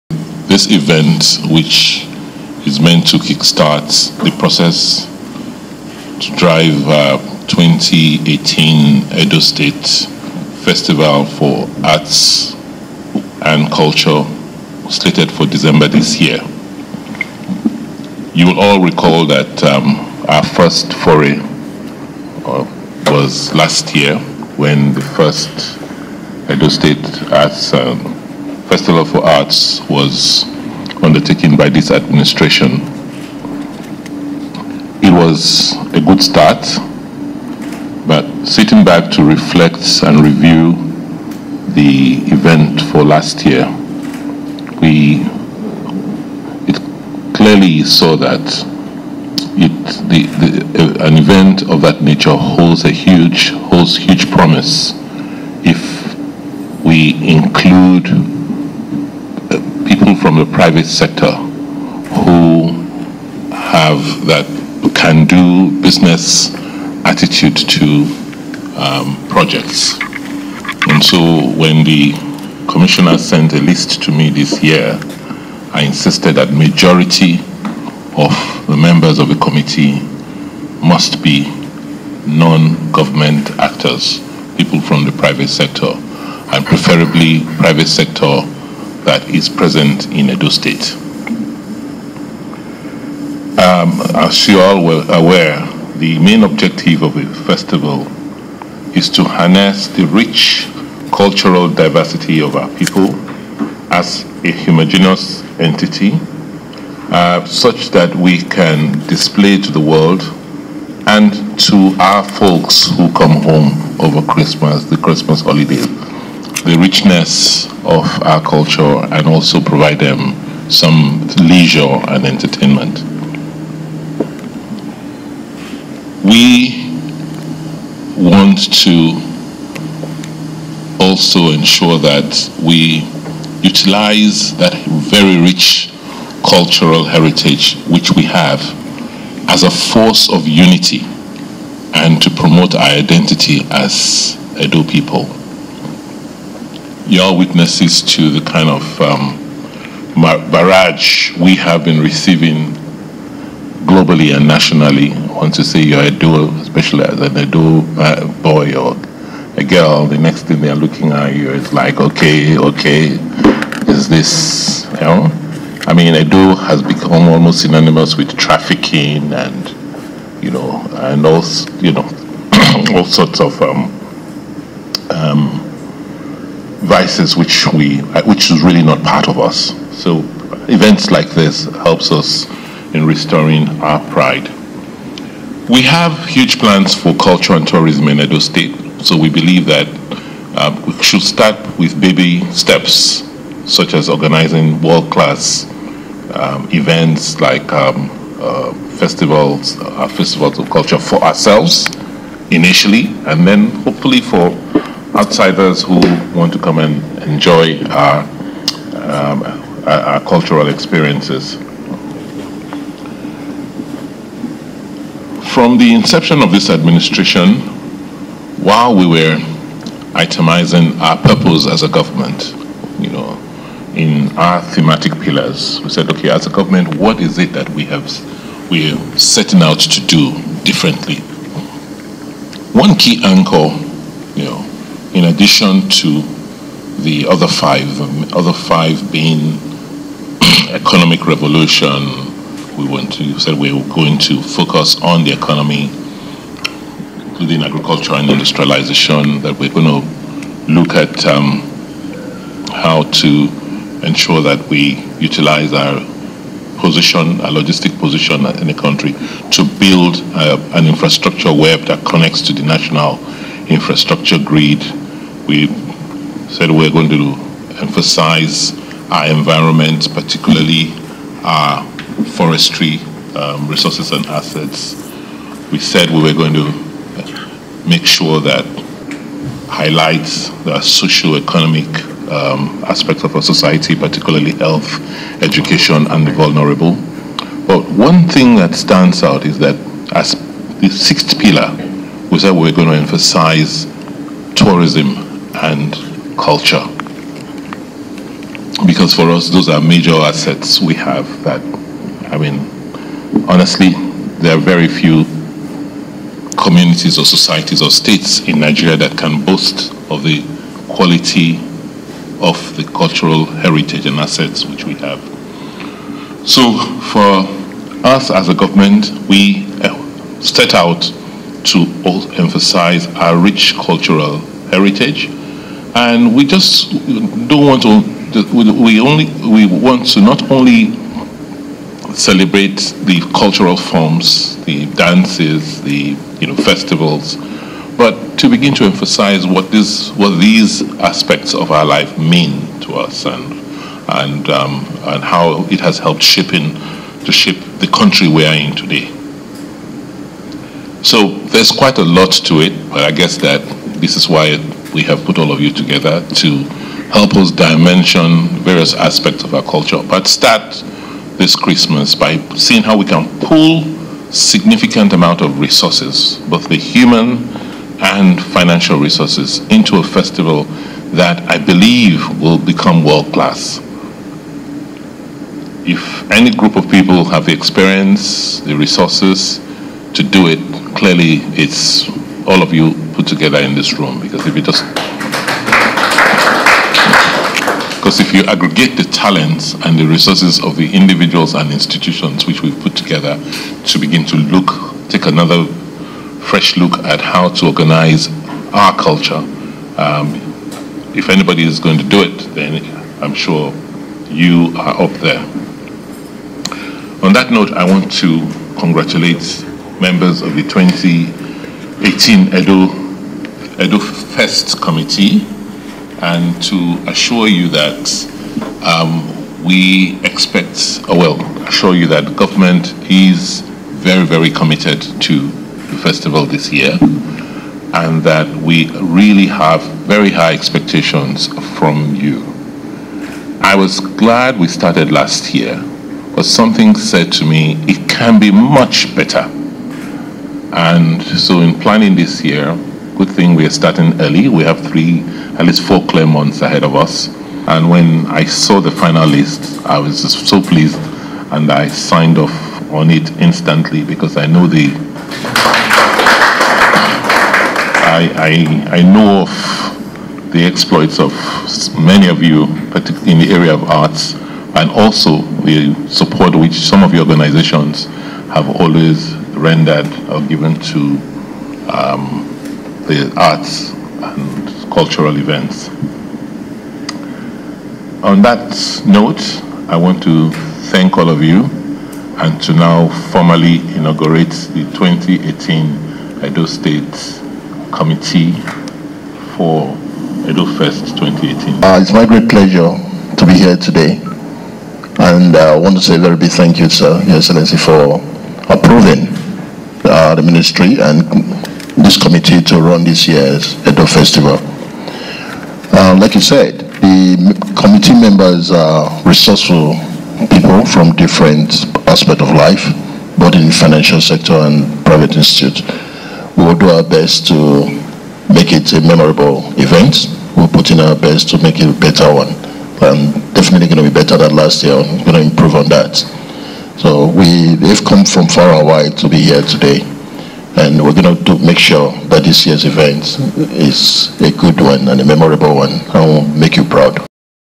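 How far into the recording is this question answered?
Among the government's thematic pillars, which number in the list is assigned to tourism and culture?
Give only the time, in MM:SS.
04:50.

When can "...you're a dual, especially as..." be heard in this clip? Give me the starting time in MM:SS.
02:35.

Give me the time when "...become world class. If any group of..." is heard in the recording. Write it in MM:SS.
06:12.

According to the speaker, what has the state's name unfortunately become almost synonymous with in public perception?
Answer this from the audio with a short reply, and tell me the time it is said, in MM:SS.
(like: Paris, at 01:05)
trafficking, at 02:48.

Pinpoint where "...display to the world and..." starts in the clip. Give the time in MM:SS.
01:49.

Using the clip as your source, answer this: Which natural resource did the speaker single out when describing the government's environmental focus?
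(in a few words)
forestry.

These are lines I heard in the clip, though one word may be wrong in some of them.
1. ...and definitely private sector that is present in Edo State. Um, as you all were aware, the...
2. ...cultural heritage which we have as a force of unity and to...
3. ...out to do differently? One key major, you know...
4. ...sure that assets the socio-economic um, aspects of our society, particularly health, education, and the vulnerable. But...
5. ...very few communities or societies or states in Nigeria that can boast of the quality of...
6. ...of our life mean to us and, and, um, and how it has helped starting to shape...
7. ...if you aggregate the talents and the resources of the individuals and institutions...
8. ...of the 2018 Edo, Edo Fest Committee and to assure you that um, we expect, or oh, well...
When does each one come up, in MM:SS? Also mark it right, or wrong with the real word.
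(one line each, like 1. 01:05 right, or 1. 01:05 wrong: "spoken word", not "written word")
1. 01:26 wrong: "preferably", not "definitely"
2. 02:16 right
3. 03:49 wrong: "anchor", not "major"
4. 04:38 wrong: "highlights", not "assets"
5. 05:04 right
6. 05:41 wrong: "shaping", not "starting"
7. 06:28 right
8. 06:50 right.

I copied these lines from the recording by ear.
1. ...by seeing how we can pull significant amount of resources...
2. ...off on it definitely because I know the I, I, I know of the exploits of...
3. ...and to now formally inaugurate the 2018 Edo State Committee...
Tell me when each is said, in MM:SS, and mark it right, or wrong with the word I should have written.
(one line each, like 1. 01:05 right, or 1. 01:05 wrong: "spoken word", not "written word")
1. 06:02 right
2. 07:32 wrong: "instantly", not "definitely"
3. 08:02 right.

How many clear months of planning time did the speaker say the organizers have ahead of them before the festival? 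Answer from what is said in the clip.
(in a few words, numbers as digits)
4.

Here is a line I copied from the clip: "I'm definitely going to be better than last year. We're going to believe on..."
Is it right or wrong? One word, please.
wrong.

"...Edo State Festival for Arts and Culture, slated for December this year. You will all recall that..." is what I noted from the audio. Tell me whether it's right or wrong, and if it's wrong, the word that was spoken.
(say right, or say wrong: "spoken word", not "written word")
right.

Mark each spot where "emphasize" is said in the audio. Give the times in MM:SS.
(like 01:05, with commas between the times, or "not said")
04:27, 04:52, 05:22, 05:38.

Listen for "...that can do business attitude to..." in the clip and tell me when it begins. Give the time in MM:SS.
01:04.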